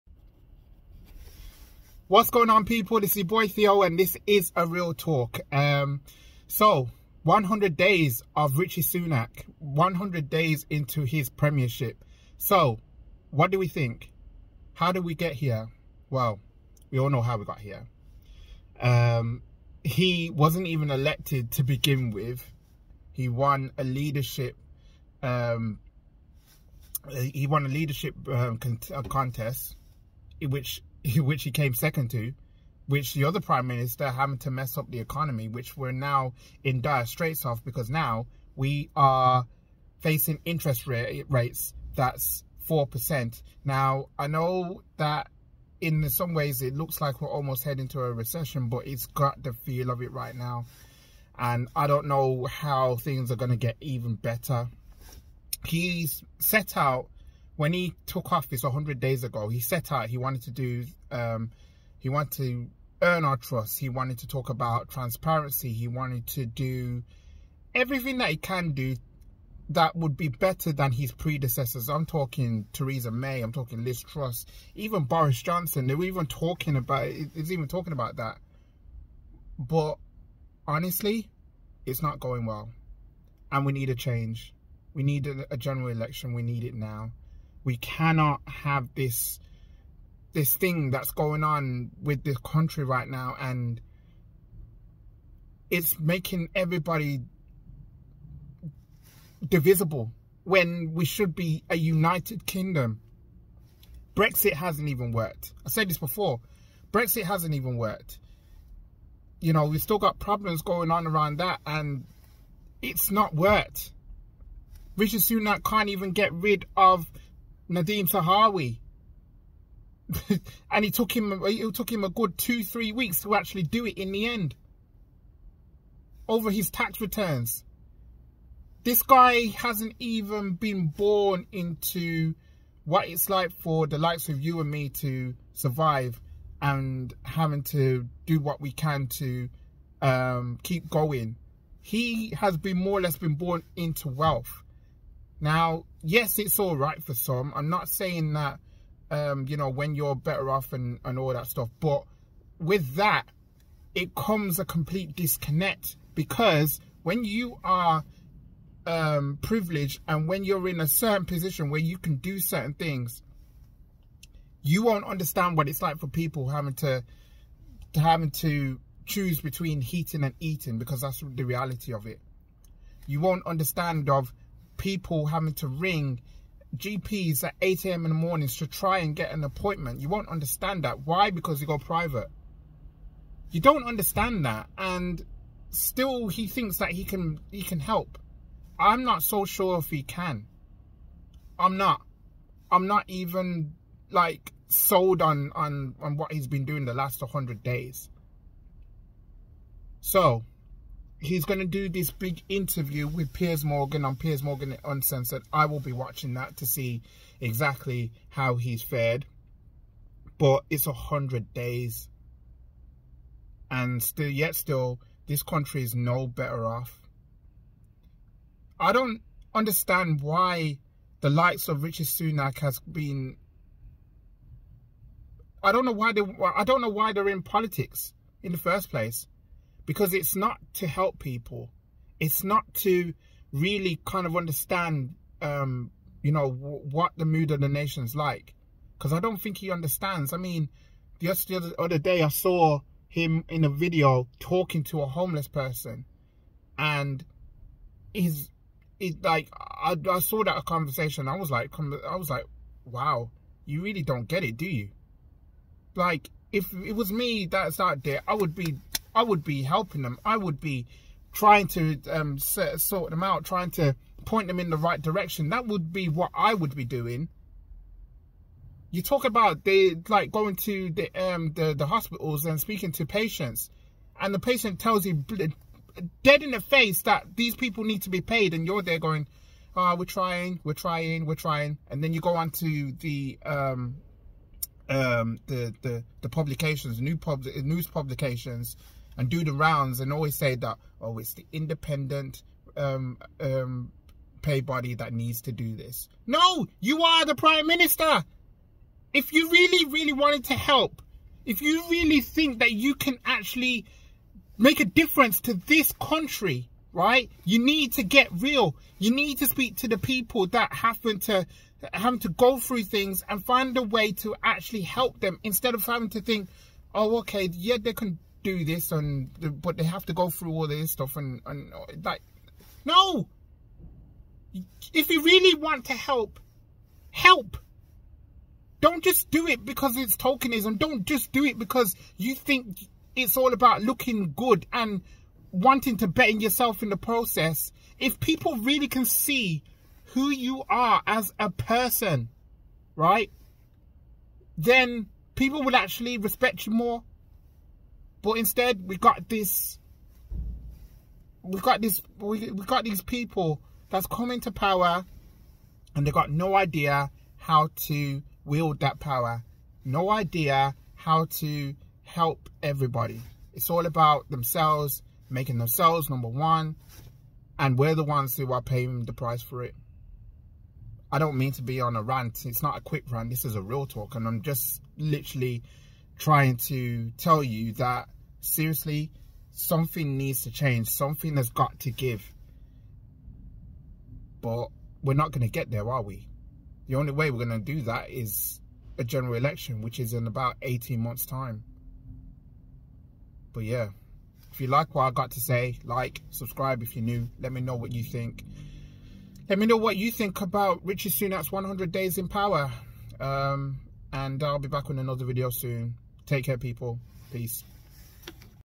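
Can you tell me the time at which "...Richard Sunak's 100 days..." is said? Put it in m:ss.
6:40.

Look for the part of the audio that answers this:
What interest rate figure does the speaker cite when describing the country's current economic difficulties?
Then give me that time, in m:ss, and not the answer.
0:42.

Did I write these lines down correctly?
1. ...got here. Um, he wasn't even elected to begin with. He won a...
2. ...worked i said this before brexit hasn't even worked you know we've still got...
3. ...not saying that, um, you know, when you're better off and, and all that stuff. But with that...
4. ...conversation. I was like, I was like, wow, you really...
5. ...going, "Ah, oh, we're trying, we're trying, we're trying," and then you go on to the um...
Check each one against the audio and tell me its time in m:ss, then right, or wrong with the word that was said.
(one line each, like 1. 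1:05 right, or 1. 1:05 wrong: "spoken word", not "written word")
1. 0:17 right
2. 1:45 right
3. 2:27 right
4. 4:10 right
5. 4:38 right.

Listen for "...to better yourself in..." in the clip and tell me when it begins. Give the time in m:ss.
5:35.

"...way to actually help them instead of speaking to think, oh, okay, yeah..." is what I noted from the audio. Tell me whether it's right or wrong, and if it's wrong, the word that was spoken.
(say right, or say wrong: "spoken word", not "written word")
wrong: "having", not "speaking".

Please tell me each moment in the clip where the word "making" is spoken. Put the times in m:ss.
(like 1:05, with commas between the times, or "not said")
1:35, 6:05.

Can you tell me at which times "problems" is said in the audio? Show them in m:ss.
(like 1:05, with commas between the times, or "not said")
1:50.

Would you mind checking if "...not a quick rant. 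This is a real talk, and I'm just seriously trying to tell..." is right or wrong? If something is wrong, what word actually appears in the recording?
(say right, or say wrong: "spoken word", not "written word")
wrong: "literally", not "seriously".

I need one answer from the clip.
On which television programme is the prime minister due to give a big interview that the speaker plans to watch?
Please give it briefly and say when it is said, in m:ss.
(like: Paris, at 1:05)
Piers Morgan Uncensored, at 3:24.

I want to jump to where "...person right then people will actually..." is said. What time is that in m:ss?
5:41.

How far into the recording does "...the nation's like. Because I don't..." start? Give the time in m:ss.
3:57.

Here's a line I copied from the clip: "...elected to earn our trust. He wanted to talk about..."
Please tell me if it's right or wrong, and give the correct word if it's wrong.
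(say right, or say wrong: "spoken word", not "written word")
wrong: "wanted", not "elected".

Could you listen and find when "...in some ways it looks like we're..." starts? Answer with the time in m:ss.
0:45.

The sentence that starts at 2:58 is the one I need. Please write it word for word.
in the mornings to try and get an appointment.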